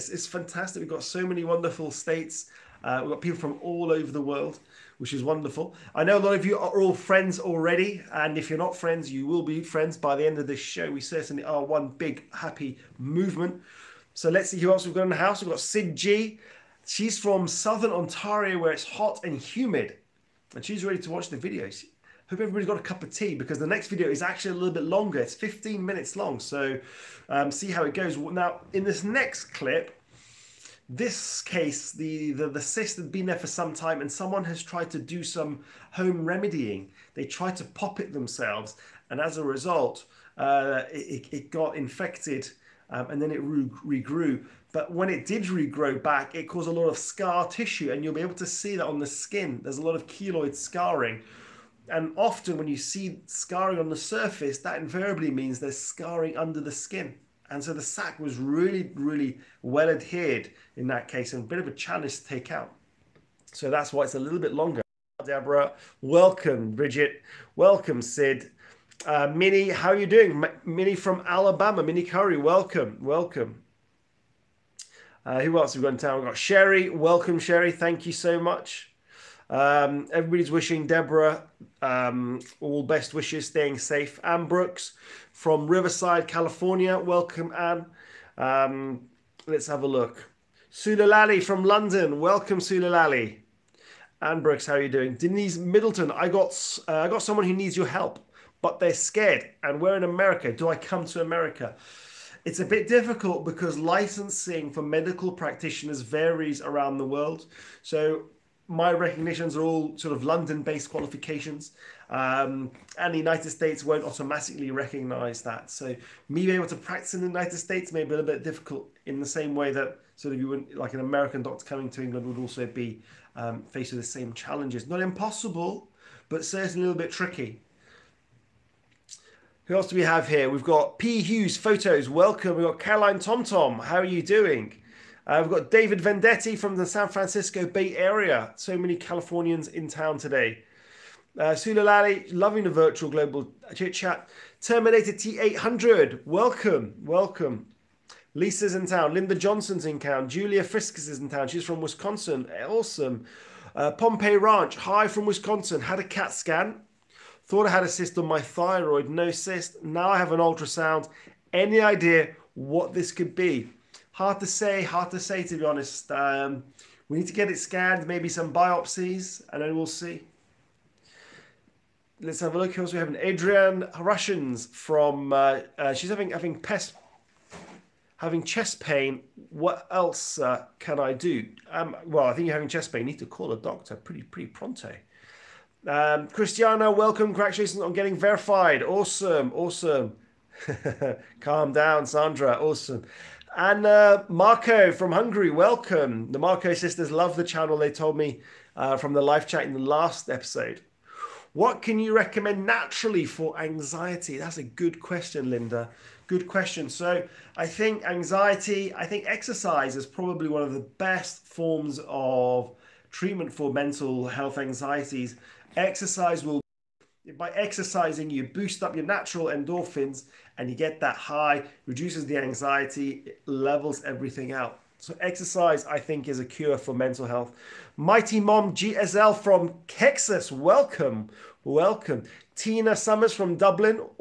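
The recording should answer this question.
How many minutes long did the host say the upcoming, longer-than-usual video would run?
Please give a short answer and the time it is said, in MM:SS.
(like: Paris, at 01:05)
15, at 00:25.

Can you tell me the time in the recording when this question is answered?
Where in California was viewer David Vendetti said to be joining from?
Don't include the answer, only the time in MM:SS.
02:16.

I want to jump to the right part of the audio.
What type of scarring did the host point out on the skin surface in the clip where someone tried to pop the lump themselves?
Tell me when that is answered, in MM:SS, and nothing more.
00:50.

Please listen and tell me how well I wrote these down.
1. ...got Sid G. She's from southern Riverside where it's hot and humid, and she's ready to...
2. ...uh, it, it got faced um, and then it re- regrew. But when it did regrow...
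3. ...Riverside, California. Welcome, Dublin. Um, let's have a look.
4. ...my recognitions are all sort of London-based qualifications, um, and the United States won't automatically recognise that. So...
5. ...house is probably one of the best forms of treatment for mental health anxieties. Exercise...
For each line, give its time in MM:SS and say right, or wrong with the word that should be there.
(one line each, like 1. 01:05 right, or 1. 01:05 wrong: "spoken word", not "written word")
1. 00:15 wrong: "Ontario", not "Riverside"
2. 00:40 wrong: "infected", not "faced"
3. 01:25 wrong: "Anne", not "Dublin"
4. 01:48 right
5. 03:29 wrong: "exercise", not "house".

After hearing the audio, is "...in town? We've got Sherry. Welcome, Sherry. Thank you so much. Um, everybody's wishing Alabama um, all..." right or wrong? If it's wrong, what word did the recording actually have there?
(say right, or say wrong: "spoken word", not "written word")
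wrong: "Deborah", not "Alabama".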